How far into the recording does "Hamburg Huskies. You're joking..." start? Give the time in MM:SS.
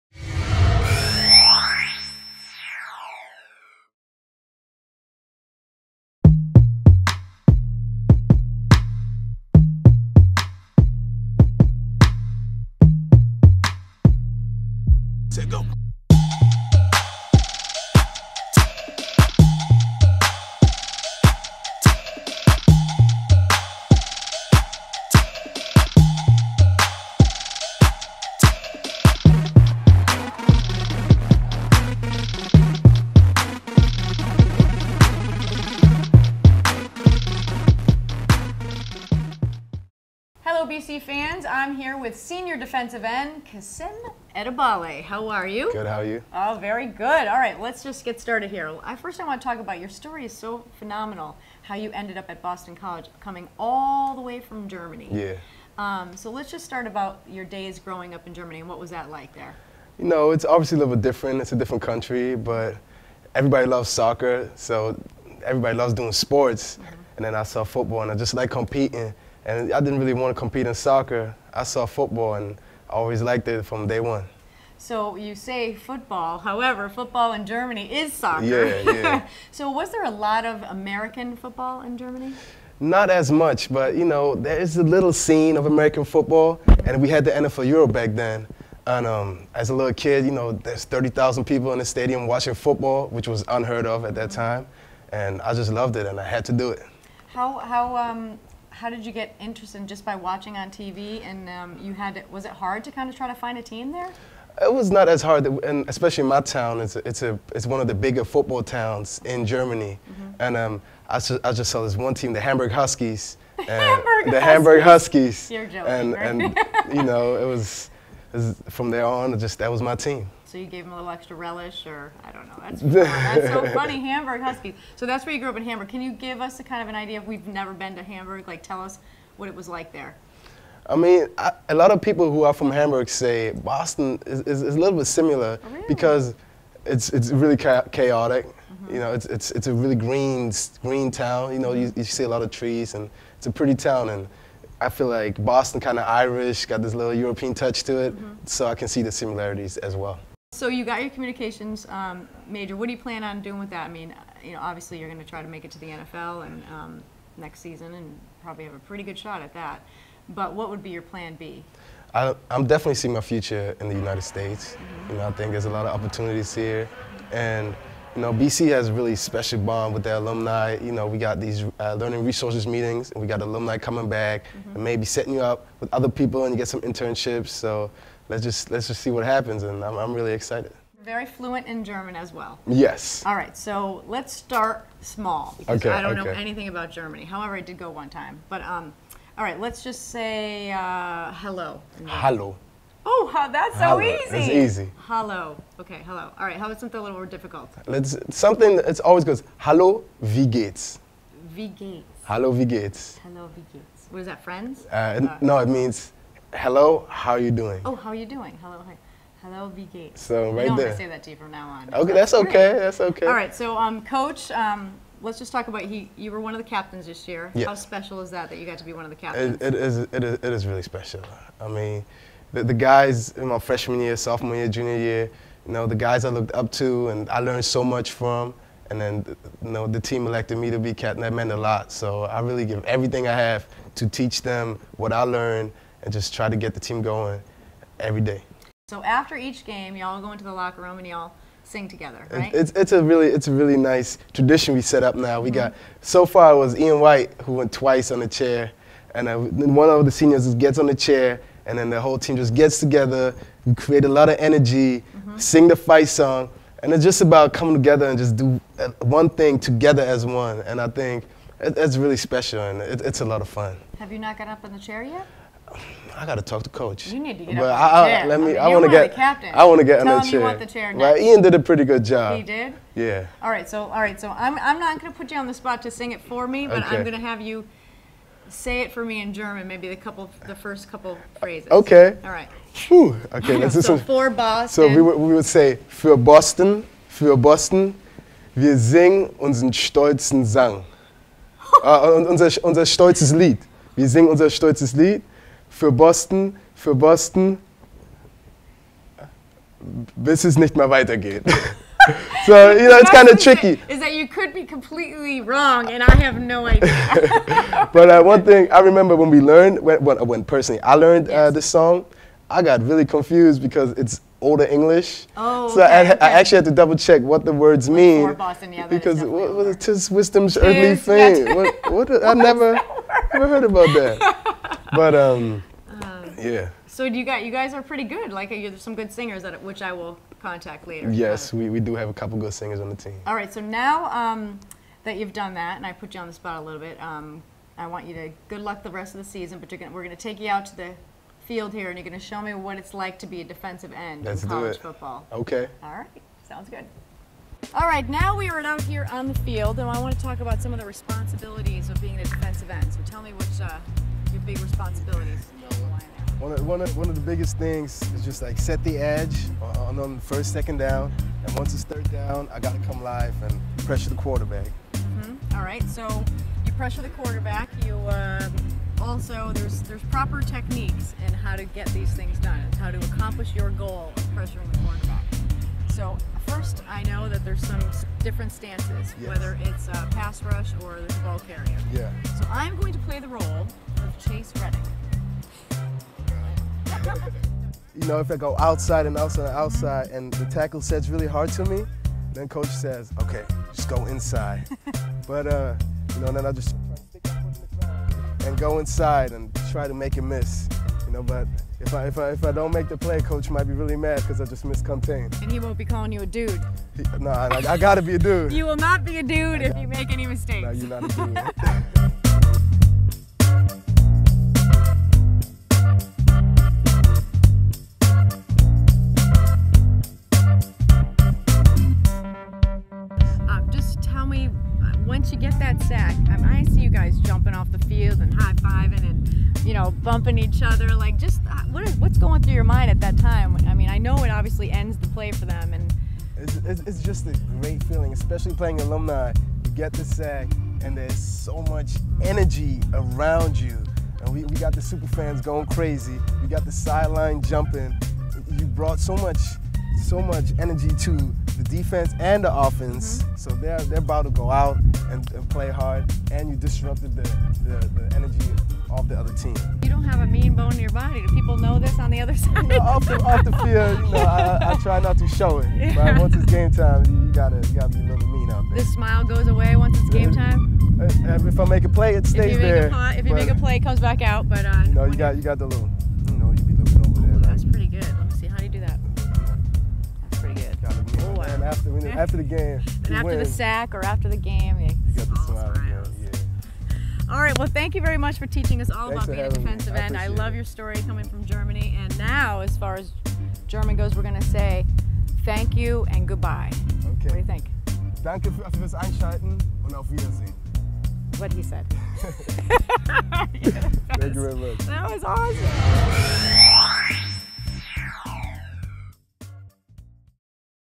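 01:54.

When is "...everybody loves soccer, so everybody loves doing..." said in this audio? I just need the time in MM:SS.
01:03.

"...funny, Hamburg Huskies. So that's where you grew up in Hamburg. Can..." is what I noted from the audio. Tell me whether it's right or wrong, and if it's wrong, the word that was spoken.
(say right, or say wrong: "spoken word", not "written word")
right.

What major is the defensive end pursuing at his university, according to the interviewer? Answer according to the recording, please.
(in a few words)
Communications.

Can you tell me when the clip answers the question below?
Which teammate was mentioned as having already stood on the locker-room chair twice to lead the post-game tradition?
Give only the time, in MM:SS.
04:06.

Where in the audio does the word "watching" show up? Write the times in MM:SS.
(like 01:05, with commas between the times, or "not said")
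01:32, 01:40.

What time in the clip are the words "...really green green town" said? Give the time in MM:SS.
02:19.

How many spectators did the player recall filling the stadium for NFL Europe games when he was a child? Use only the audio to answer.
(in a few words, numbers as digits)
30,000.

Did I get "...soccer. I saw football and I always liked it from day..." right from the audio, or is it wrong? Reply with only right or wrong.
right.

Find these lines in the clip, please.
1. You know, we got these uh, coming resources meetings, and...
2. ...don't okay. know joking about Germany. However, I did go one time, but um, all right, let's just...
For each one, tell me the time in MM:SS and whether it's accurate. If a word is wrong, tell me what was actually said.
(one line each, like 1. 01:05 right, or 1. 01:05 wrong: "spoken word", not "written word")
1. 02:50 wrong: "learning", not "coming"
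2. 03:06 wrong: "anything", not "joking".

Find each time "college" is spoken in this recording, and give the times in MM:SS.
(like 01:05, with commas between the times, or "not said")
00:52, 05:44.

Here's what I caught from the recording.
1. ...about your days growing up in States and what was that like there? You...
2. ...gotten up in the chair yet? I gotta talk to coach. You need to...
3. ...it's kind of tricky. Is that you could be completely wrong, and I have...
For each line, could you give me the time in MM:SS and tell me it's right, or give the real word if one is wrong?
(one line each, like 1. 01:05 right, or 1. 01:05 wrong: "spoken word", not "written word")
1. 00:56 wrong: "Germany", not "States"
2. 04:24 right
3. 05:02 right.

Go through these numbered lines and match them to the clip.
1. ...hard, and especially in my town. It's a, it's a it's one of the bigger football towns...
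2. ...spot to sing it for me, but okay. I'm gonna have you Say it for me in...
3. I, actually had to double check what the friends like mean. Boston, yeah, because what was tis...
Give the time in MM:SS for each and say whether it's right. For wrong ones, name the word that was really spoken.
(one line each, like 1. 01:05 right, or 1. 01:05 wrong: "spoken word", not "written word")
1. 01:45 right
2. 04:35 right
3. 05:16 wrong: "words", not "friends".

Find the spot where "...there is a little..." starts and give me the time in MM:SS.
01:24.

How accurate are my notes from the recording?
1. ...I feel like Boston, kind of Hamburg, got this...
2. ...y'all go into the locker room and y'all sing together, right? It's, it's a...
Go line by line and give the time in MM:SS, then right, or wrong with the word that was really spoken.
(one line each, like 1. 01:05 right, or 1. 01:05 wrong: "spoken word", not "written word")
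1. 02:24 wrong: "Irish", not "Hamburg"
2. 03:59 right.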